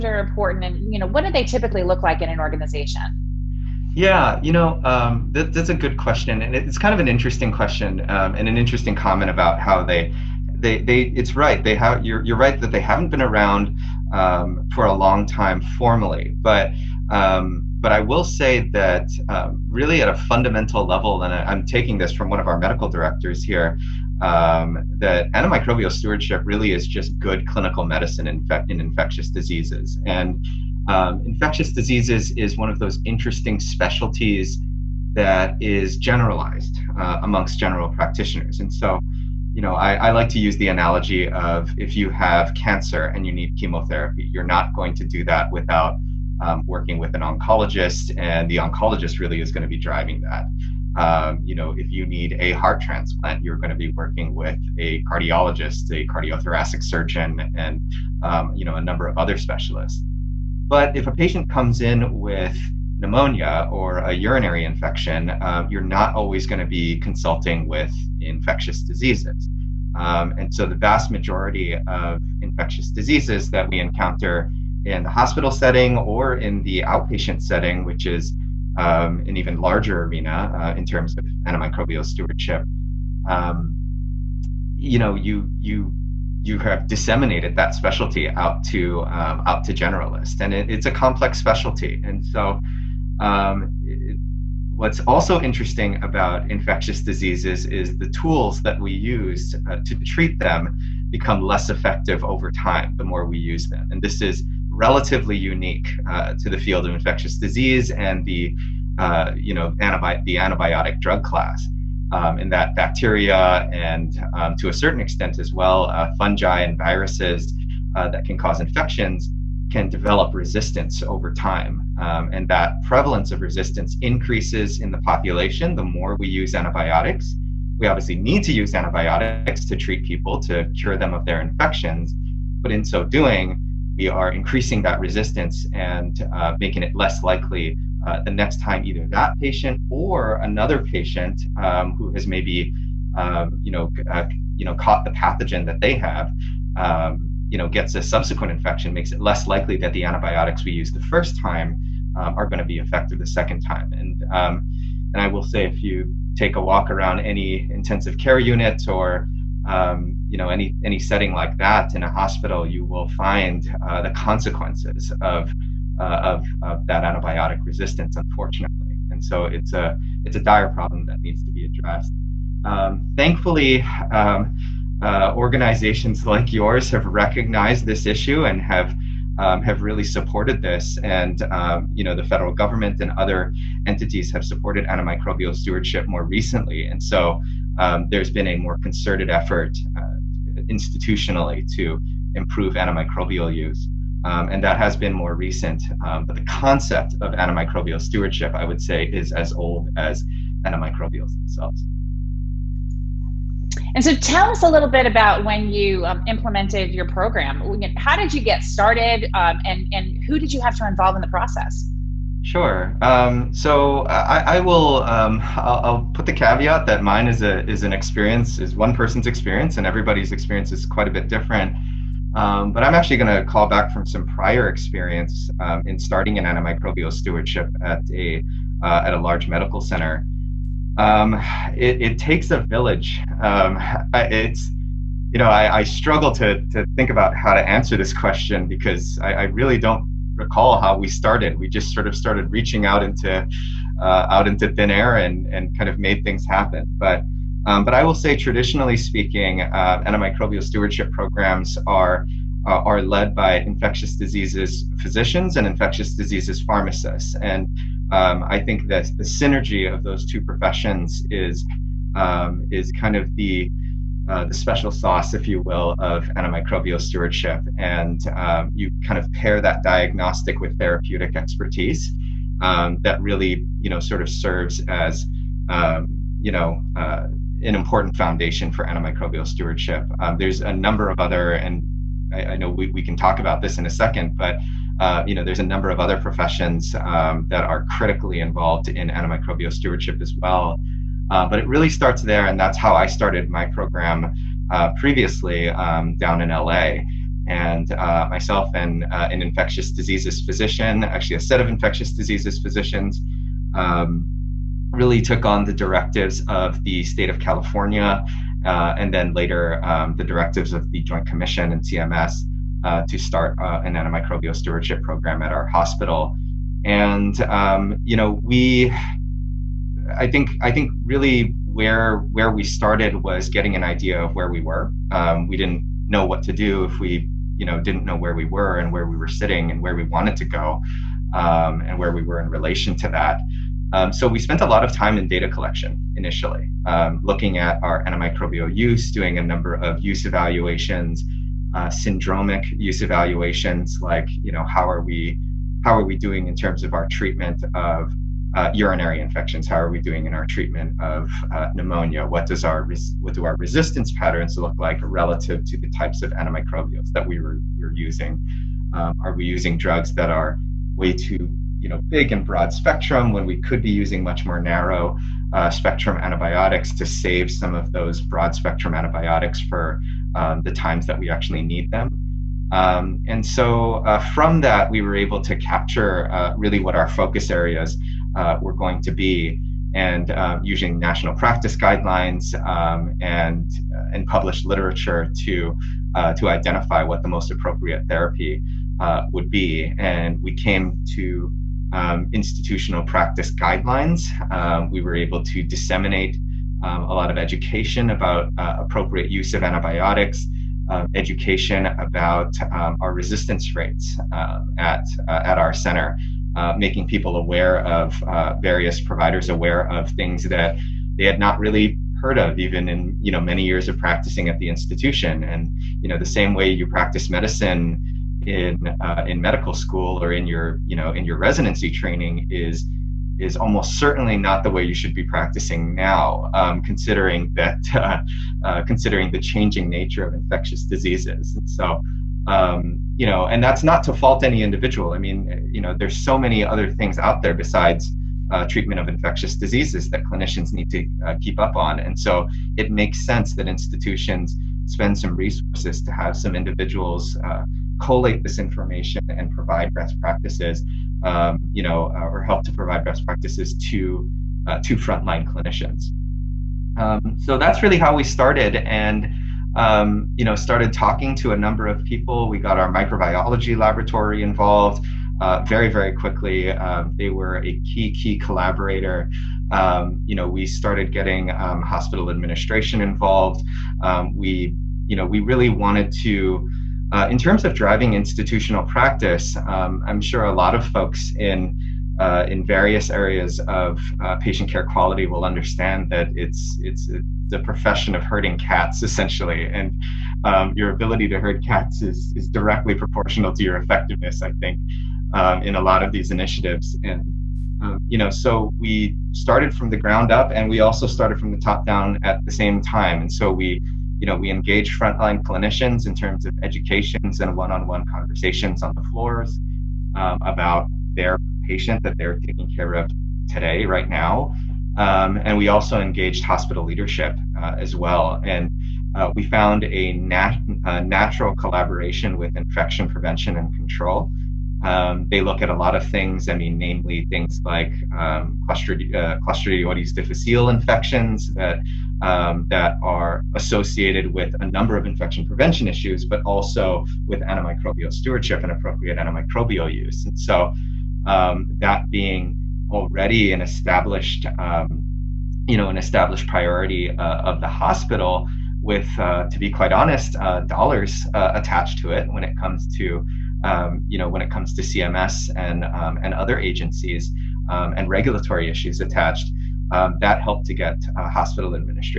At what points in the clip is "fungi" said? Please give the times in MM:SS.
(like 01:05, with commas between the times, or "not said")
01:56.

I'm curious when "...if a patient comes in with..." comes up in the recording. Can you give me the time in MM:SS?
01:00.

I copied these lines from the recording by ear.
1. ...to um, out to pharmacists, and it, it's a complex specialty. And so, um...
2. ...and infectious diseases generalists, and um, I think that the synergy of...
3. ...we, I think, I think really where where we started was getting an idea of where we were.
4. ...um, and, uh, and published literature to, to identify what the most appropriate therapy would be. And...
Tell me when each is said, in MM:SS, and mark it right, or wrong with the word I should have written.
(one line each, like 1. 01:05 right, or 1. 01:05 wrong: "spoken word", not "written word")
1. 01:28 wrong: "generalists", not "pharmacists"
2. 04:15 wrong: "pharmacists", not "generalists"
3. 05:18 right
4. 06:22 right.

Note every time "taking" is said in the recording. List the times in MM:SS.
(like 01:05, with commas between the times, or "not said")
00:21, 08:32.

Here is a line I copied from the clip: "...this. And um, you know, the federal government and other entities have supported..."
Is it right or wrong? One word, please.
right.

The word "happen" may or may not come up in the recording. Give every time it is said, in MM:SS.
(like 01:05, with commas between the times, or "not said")
04:06.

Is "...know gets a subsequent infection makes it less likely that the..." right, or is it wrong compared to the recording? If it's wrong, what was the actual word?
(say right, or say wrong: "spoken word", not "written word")
right.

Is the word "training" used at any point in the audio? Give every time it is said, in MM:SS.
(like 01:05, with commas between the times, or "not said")
07:01.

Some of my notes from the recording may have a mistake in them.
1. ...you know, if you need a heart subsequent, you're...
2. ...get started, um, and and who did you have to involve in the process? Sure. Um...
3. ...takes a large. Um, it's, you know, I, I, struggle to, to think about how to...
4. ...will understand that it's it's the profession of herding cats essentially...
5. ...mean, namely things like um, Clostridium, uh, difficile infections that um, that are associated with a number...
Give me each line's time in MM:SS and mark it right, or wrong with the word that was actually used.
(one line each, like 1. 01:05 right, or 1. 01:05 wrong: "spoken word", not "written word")
1. 00:51 wrong: "transplant", not "subsequent"
2. 03:28 right
3. 03:52 wrong: "village", not "large"
4. 08:05 right
5. 08:46 right.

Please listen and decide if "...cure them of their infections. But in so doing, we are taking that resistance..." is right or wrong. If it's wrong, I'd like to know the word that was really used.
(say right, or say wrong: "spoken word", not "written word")
wrong: "increasing", not "taking".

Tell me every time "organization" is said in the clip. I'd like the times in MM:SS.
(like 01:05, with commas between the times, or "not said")
00:02, 02:55.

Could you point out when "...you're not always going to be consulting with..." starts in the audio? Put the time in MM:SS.
01:05.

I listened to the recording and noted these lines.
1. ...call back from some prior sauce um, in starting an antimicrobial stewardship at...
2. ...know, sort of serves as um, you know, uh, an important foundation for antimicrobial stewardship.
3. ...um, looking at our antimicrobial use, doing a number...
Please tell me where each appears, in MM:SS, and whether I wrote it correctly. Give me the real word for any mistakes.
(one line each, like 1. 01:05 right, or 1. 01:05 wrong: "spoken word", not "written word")
1. 03:43 wrong: "experience", not "sauce"
2. 04:33 right
3. 05:36 right.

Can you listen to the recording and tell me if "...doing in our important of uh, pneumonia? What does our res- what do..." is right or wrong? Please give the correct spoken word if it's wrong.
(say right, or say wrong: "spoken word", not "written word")
wrong: "treatment", not "important".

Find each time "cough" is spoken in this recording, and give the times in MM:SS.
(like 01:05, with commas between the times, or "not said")
not said.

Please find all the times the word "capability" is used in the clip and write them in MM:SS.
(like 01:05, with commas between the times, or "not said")
not said.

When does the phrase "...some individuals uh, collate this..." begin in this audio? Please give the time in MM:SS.
07:26.